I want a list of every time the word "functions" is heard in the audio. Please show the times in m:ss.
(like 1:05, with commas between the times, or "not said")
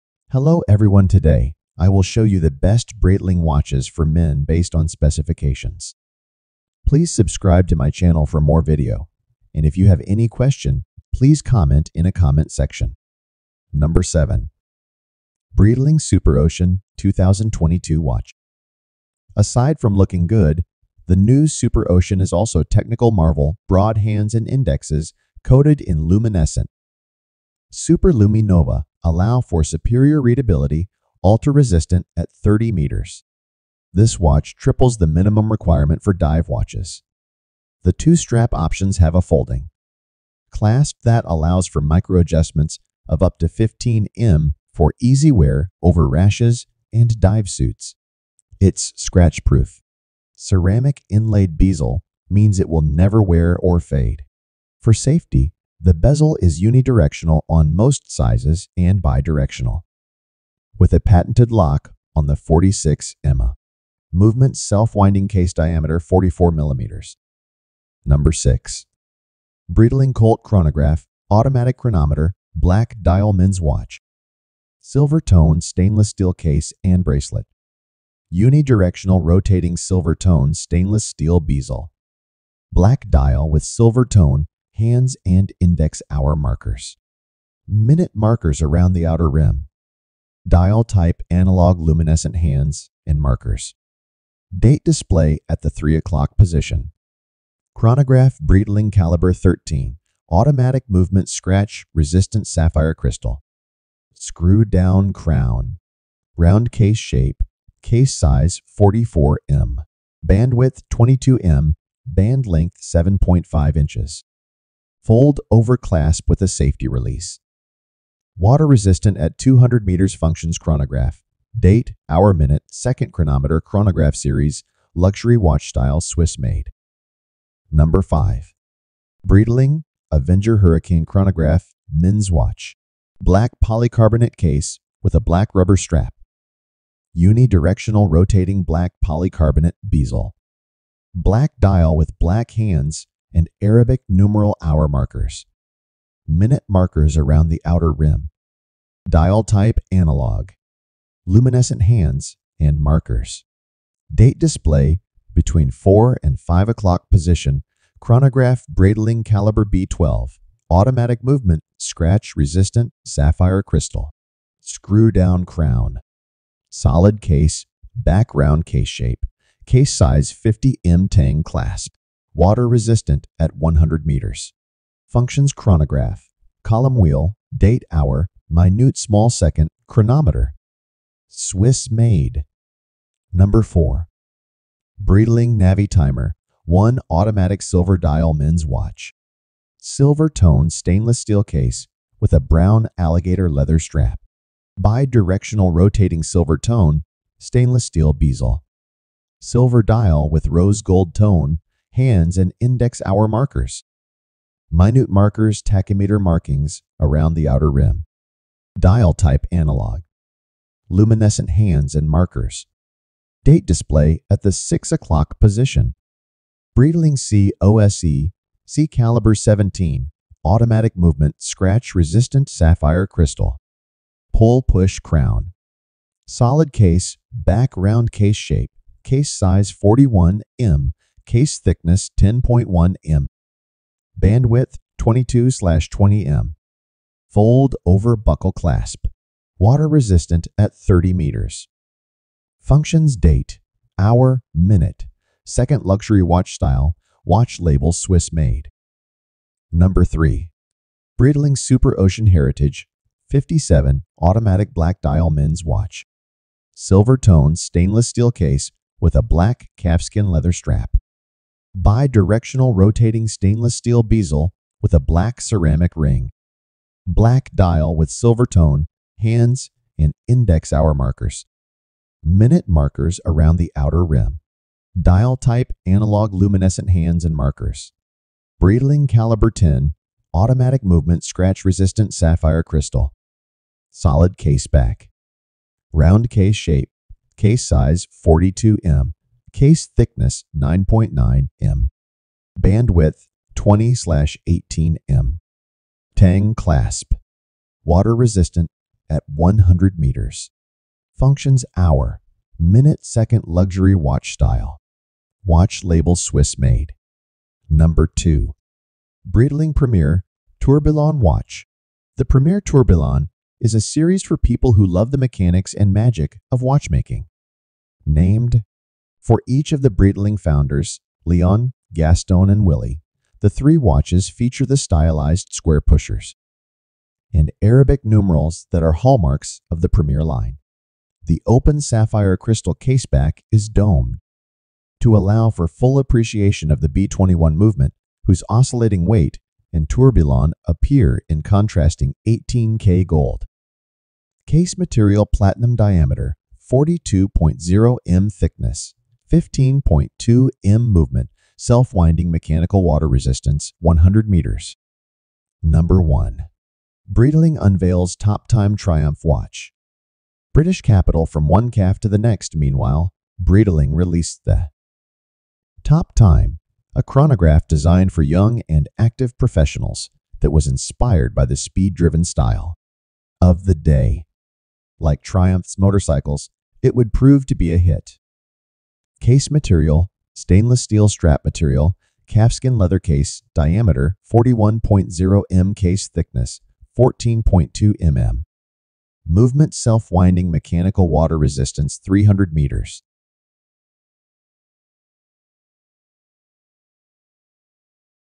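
2:00, 2:55, 4:02, 5:01.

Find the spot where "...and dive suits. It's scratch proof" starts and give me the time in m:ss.
0:46.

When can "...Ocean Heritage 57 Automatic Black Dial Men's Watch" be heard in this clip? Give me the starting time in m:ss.
4:11.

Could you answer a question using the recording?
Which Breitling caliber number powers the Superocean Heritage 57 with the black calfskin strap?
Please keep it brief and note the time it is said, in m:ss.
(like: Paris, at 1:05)
Caliber 10, at 4:39.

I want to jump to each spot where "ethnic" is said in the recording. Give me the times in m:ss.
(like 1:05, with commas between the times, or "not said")
not said.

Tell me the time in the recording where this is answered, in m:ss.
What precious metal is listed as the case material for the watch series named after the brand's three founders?
5:45.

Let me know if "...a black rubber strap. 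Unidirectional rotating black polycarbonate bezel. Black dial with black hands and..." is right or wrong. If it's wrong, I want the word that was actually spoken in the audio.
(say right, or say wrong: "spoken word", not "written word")
right.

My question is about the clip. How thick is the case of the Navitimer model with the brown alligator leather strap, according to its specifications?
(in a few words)
10.1 mm.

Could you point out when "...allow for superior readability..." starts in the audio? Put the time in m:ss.
0:29.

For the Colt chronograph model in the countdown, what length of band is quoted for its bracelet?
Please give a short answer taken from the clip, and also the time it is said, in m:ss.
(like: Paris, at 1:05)
7.5 inches, at 1:52.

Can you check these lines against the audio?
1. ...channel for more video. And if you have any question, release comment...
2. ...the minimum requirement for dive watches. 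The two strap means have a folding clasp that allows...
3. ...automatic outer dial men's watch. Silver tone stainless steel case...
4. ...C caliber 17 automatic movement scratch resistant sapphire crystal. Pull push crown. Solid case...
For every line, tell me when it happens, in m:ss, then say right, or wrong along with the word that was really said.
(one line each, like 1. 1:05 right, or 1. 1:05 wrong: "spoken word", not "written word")
1. 0:07 wrong: "please", not "release"
2. 0:34 wrong: "options", not "means"
3. 3:07 wrong: "silver", not "outer"
4. 3:38 right.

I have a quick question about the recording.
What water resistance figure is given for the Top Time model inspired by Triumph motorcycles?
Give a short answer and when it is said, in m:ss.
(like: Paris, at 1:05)
300 meters, at 6:32.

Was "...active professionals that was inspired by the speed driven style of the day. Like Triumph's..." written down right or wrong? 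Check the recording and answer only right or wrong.
right.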